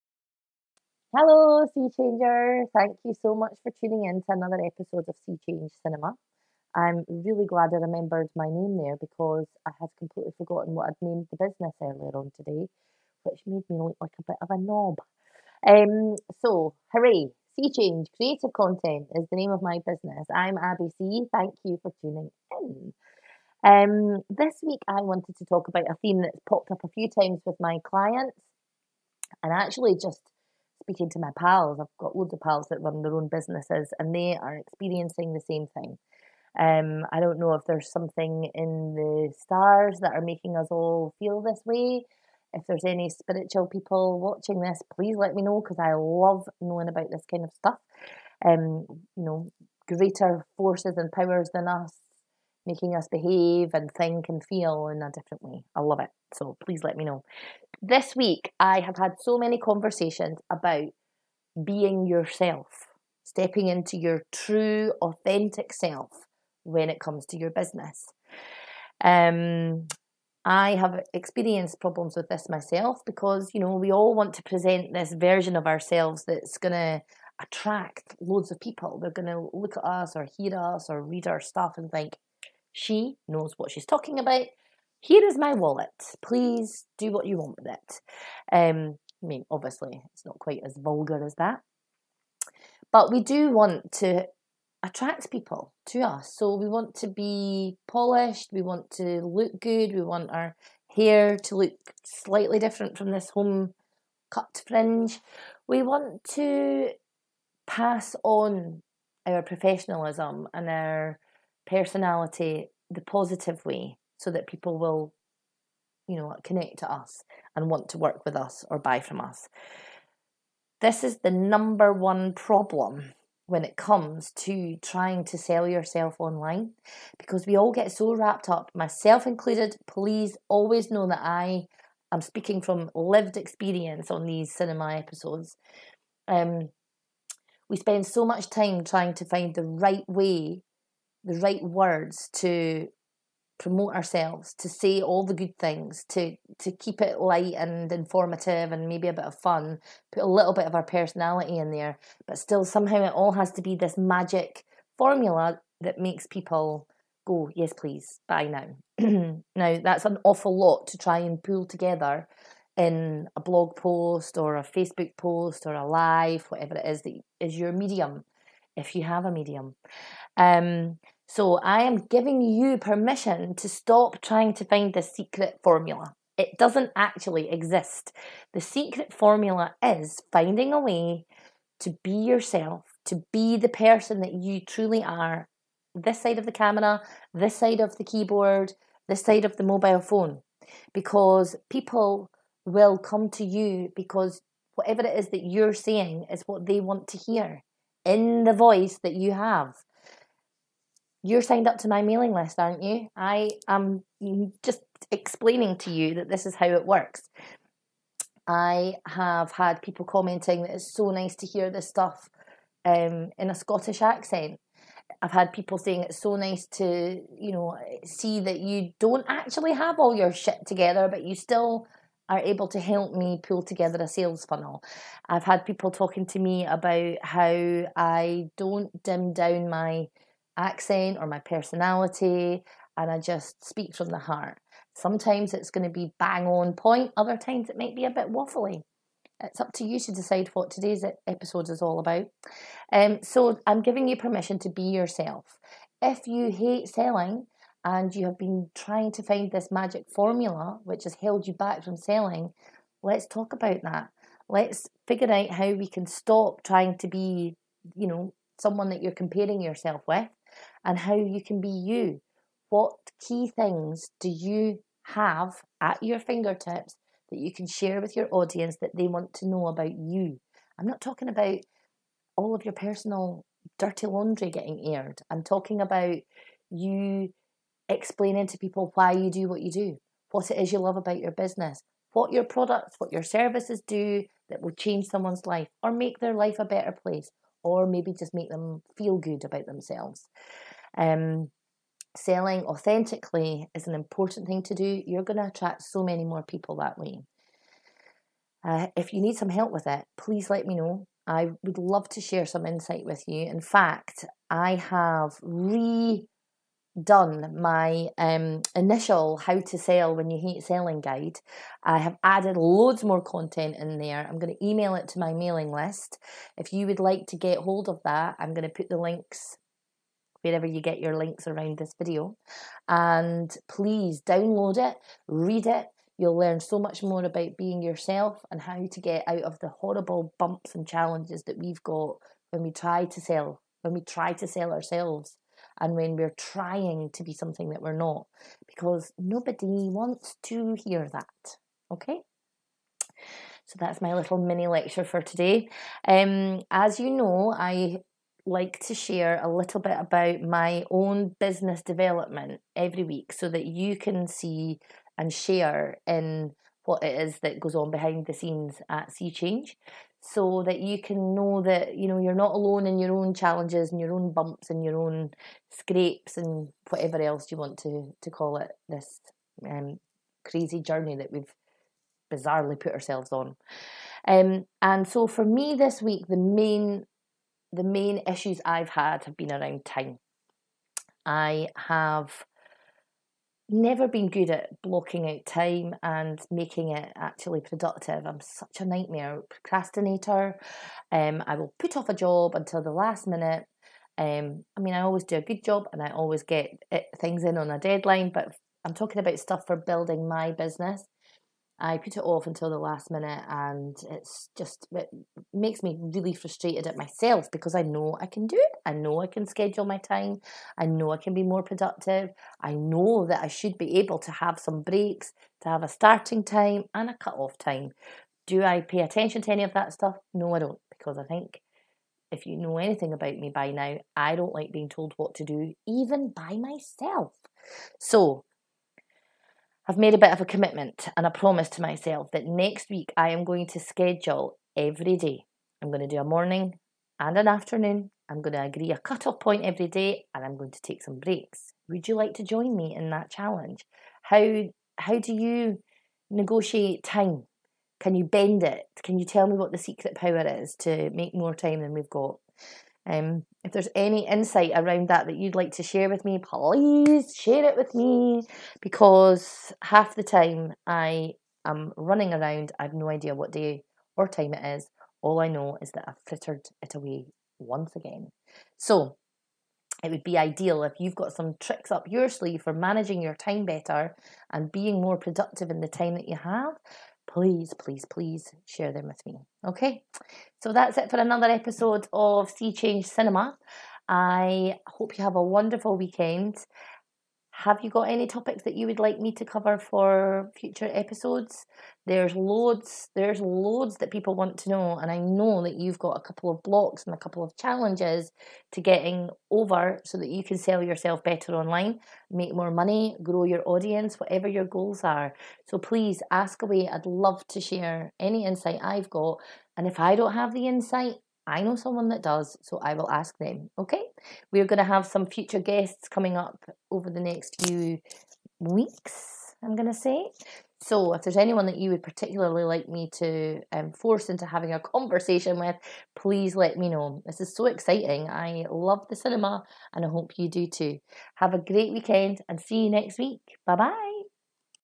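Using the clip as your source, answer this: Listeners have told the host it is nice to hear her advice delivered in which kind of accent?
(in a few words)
Scottish.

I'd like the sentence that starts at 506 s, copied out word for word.
I'd love to share any insight I've got.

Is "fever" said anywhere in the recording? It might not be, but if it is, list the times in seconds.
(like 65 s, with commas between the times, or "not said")
not said.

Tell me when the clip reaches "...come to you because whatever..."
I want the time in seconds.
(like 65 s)
192 s.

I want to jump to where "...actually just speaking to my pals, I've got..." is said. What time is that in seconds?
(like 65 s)
29 s.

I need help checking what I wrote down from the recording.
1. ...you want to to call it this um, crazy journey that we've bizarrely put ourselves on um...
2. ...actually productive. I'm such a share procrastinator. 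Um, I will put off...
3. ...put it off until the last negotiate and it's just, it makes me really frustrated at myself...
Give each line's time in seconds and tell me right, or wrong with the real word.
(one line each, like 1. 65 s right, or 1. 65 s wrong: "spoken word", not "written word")
1. 367 s right
2. 387 s wrong: "nightmare", not "share"
3. 401 s wrong: "minute", not "negotiate".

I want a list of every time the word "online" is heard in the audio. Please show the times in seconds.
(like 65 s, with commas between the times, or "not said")
126 s, 501 s.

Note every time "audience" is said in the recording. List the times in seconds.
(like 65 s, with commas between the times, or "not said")
268 s, 503 s.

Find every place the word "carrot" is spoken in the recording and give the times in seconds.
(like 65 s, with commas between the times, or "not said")
not said.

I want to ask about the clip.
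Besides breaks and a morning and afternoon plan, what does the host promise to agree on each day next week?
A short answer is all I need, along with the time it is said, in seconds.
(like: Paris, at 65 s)
cut-off point, at 438 s.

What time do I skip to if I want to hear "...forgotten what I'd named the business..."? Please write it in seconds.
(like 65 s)
10 s.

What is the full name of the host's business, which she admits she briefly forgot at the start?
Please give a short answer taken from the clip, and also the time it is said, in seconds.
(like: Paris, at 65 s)
Sea Change Creative Content, at 17 s.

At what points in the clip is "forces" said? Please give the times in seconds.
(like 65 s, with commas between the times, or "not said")
50 s, 523 s.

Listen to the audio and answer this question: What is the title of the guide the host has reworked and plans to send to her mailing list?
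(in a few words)
How to sell when you hate selling.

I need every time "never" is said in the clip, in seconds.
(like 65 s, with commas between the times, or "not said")
383 s.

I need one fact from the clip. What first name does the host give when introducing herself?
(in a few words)
Abi.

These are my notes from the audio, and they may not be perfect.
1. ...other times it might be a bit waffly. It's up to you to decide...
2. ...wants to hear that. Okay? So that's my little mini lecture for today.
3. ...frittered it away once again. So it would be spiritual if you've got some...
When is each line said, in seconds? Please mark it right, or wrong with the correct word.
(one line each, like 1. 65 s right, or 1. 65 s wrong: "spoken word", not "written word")
1. 237 s right
2. 339 s right
3. 466 s wrong: "ideal", not "spiritual".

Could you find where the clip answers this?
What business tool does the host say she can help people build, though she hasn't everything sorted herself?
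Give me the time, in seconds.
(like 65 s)
224 s.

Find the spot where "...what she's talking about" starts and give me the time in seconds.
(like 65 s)
83 s.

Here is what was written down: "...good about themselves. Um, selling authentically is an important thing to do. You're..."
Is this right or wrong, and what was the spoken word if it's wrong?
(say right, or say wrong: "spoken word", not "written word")
right.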